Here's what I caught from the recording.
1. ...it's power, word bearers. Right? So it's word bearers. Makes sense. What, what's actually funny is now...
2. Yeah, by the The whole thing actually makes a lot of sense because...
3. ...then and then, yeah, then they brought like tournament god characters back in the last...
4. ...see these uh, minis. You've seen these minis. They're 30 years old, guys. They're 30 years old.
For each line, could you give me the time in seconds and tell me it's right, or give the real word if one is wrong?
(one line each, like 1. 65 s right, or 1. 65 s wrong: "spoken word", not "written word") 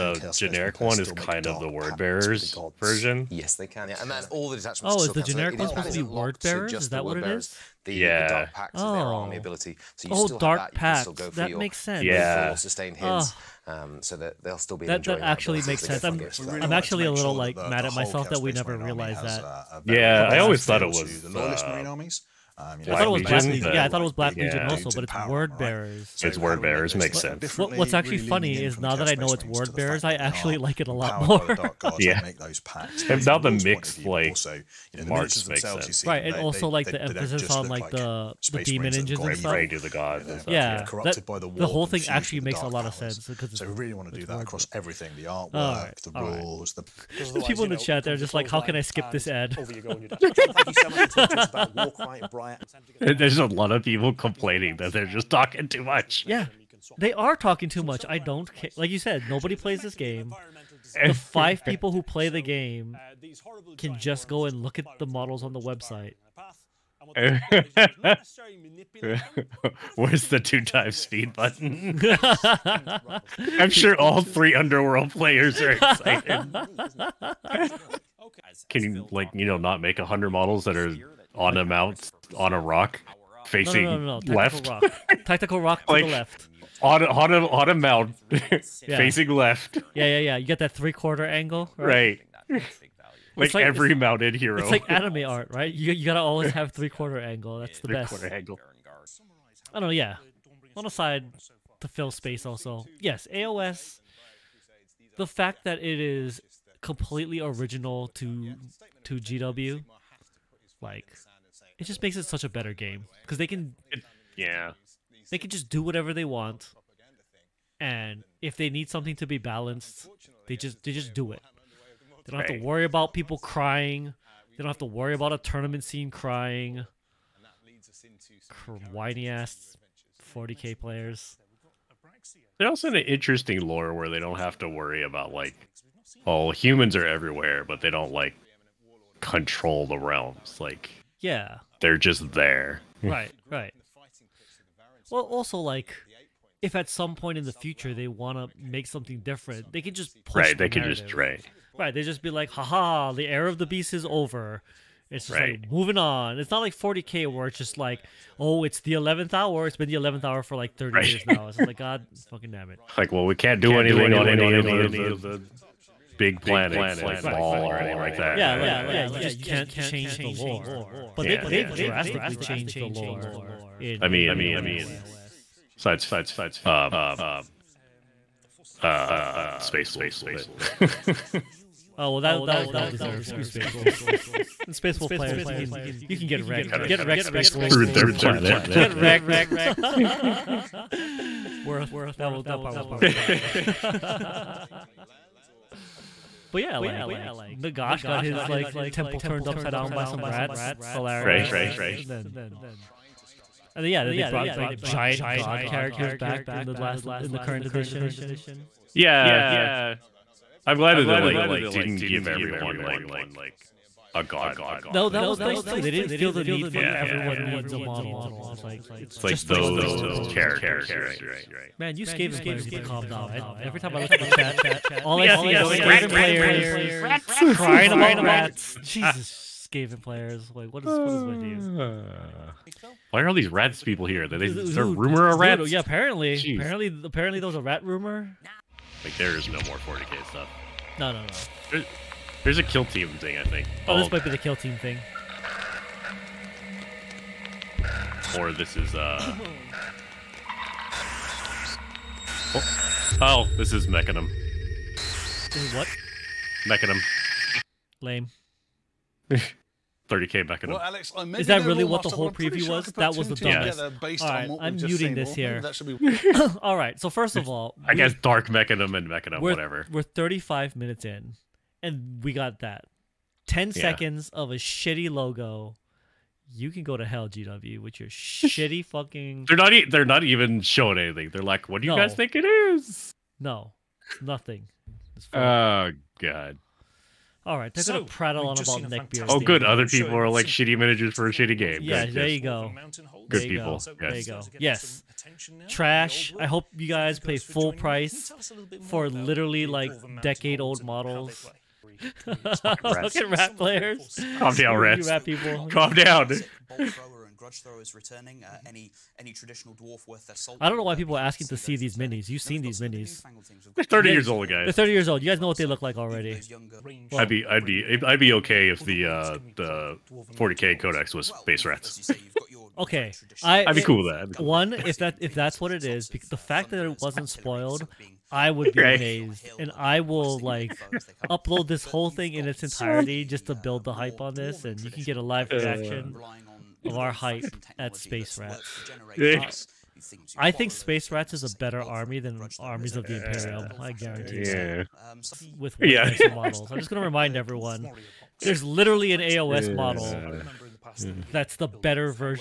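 1. 25 s right
2. 40 s right
3. 202 s wrong: "giant", not "tournament"
4. 311 s right.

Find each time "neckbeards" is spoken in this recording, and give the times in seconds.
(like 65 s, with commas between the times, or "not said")
288 s.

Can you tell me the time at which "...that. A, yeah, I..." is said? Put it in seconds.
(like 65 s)
19 s.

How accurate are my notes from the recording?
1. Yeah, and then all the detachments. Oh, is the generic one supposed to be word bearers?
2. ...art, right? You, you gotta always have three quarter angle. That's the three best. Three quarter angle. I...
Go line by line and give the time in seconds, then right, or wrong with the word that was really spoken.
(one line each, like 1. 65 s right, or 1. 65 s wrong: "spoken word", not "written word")
1. 3 s right
2. 95 s right.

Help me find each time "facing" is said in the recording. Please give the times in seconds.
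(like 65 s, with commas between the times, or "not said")
83 s, 88 s.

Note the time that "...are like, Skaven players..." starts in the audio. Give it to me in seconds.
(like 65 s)
225 s.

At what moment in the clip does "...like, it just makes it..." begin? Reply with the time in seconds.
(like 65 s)
110 s.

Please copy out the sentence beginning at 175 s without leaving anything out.
Besides, uh, uh, Space Wolves, but oh well, that that was well deserved.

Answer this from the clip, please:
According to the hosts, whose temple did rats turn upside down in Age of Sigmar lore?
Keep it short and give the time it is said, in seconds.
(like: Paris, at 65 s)
Nagash, at 197 s.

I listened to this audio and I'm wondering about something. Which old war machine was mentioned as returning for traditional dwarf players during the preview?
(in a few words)
Grudge Thrower.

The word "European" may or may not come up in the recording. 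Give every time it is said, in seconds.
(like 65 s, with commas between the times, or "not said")
not said.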